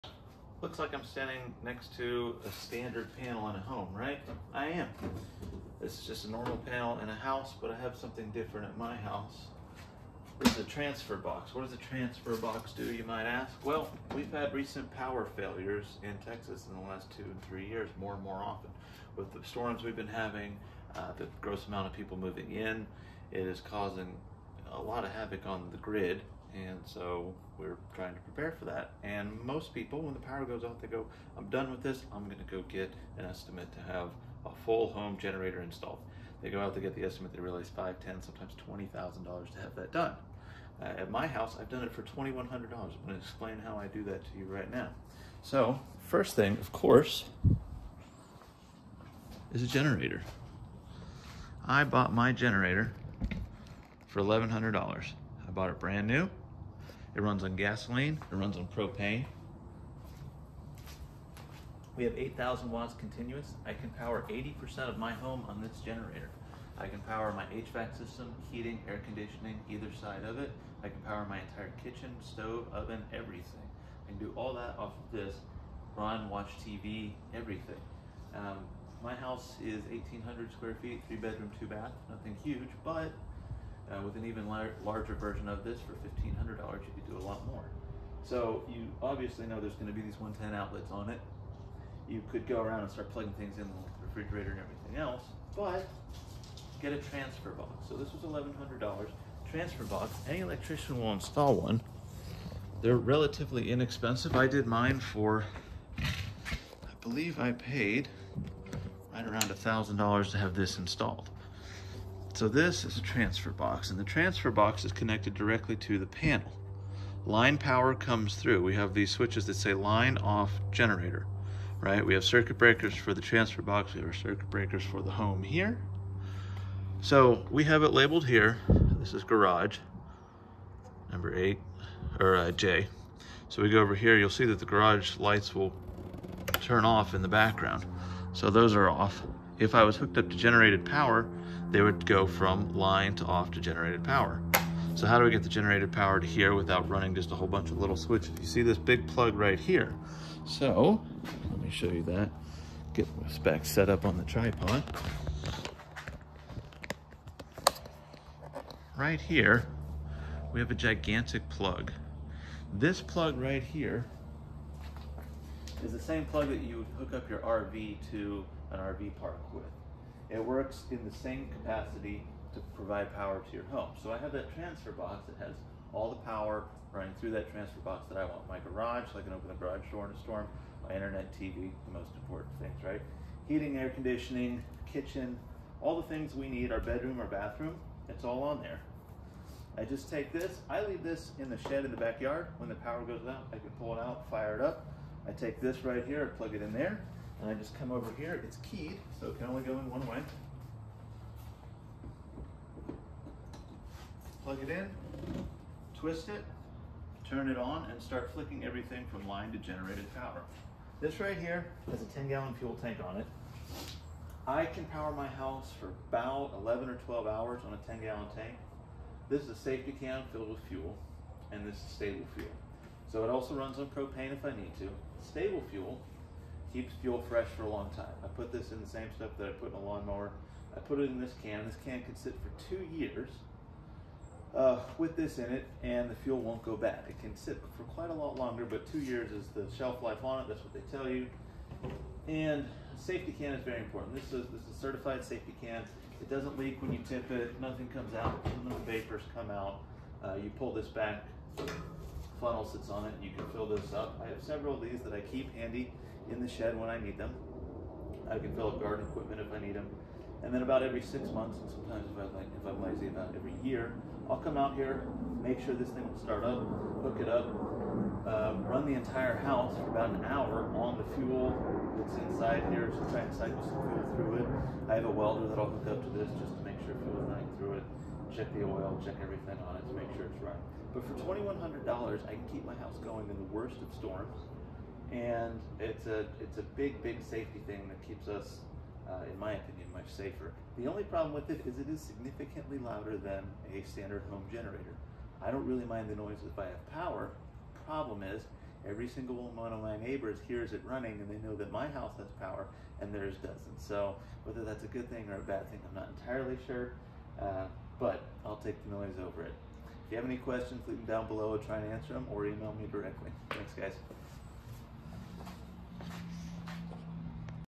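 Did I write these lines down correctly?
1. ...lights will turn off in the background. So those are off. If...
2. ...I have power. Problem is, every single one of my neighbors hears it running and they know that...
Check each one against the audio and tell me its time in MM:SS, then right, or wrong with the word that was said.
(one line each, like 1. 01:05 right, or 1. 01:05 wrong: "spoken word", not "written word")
1. 02:15 right
2. 04:56 right.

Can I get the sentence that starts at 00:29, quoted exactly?
And most people, when the power goes out, they go, I'm done with this.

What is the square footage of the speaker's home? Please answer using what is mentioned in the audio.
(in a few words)
1,800.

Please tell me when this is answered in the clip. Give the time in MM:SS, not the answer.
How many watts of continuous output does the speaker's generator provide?
01:02.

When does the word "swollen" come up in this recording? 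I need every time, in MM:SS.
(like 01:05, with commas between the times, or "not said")
not said.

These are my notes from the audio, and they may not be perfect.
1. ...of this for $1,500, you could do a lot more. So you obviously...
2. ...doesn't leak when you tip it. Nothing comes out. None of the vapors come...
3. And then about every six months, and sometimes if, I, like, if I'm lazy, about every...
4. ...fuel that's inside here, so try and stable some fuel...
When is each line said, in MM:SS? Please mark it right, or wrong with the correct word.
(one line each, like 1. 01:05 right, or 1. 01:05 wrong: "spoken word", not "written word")
1. 01:25 right
2. 04:06 right
3. 04:20 right
4. 04:31 wrong: "cycle", not "stable".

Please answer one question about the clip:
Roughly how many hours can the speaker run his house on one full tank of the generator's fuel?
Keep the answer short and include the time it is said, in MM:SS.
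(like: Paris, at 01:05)
11 or 12 hours, at 03:36.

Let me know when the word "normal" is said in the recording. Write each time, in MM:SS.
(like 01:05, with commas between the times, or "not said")
00:06.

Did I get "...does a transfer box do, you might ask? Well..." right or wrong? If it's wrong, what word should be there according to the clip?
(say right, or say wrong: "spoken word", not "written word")
right.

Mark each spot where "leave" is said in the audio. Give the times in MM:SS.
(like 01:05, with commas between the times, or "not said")
03:10, 05:10.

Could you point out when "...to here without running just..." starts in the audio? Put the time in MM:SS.
02:26.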